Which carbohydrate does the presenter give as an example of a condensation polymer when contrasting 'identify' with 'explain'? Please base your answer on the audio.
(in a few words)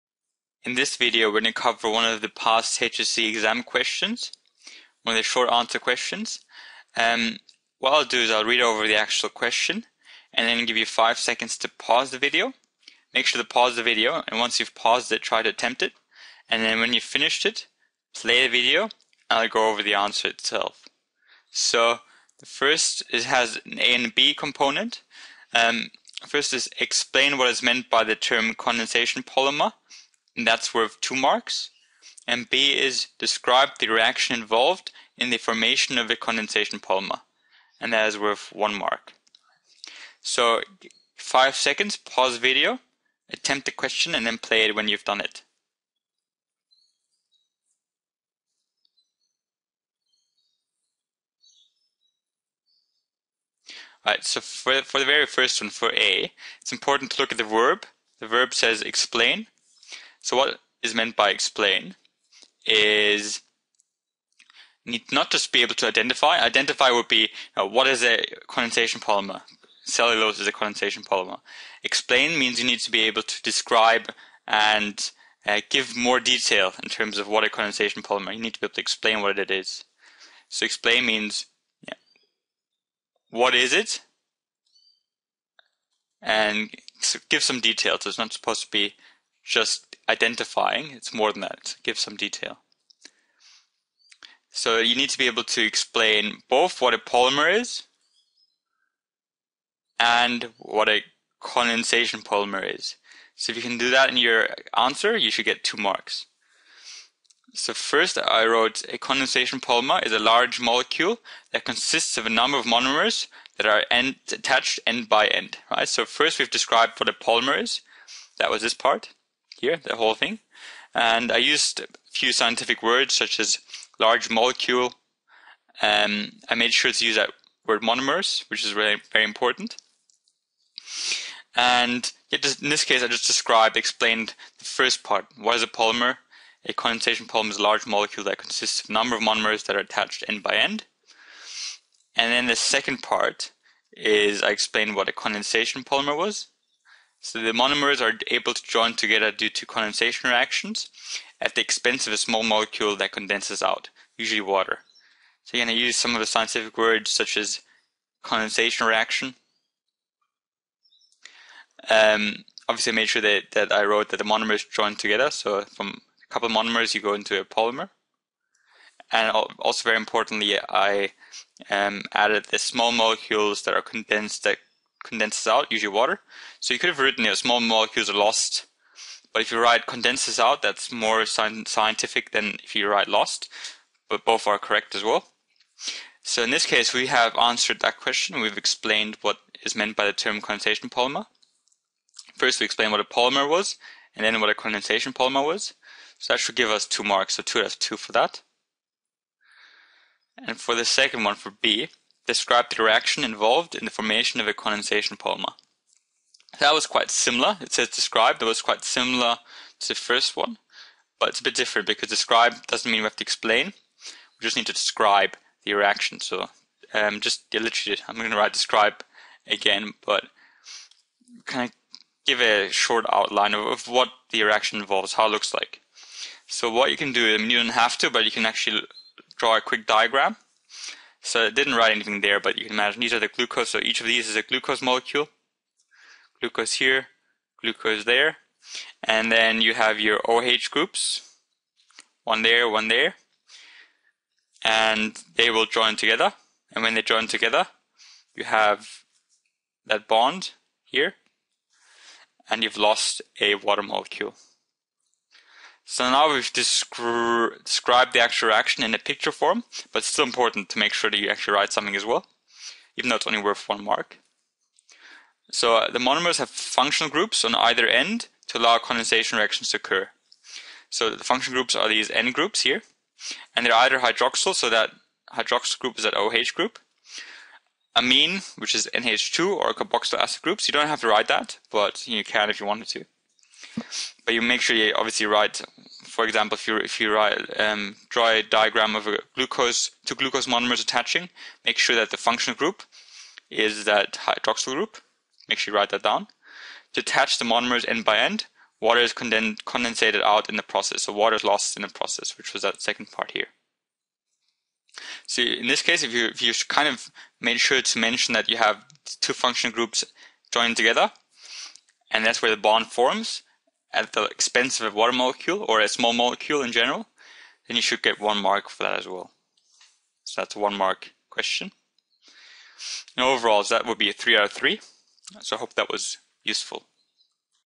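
Cellulose.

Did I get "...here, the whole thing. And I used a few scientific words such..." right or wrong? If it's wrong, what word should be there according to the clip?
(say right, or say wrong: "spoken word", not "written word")
right.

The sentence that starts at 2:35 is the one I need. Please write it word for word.
So you're going to use some of the scientific words such as condensation reaction.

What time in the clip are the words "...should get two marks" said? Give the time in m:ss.
1:45.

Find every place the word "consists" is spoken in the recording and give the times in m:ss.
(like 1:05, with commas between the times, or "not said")
1:51, 2:18.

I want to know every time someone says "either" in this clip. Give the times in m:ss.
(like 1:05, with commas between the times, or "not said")
4:27, 4:33.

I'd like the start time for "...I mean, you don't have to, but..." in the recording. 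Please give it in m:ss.
3:47.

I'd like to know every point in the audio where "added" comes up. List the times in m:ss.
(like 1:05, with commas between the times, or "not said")
2:52.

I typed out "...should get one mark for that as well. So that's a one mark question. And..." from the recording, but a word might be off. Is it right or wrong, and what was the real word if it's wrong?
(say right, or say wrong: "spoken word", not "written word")
right.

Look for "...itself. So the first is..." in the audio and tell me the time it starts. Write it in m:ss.
0:20.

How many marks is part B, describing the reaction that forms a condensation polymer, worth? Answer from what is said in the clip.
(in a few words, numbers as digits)
1.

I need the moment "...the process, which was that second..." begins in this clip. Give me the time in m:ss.
5:01.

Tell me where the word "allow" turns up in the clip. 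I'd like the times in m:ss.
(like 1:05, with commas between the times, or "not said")
4:28.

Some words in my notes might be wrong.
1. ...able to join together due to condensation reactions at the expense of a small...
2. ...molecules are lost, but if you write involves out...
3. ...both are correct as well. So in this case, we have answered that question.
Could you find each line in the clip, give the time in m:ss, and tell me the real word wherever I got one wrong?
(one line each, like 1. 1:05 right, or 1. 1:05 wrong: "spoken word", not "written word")
1. 2:28 right
2. 2:57 wrong: "condenses", not "involves"
3. 3:04 right.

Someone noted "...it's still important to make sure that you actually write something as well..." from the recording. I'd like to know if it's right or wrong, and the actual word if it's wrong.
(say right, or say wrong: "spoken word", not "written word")
right.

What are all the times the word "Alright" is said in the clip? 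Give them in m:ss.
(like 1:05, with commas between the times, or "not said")
0:54.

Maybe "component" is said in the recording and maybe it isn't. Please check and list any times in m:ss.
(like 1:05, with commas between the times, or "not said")
0:24.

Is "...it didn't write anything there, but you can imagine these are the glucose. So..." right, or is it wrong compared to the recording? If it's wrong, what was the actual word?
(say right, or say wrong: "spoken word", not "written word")
right.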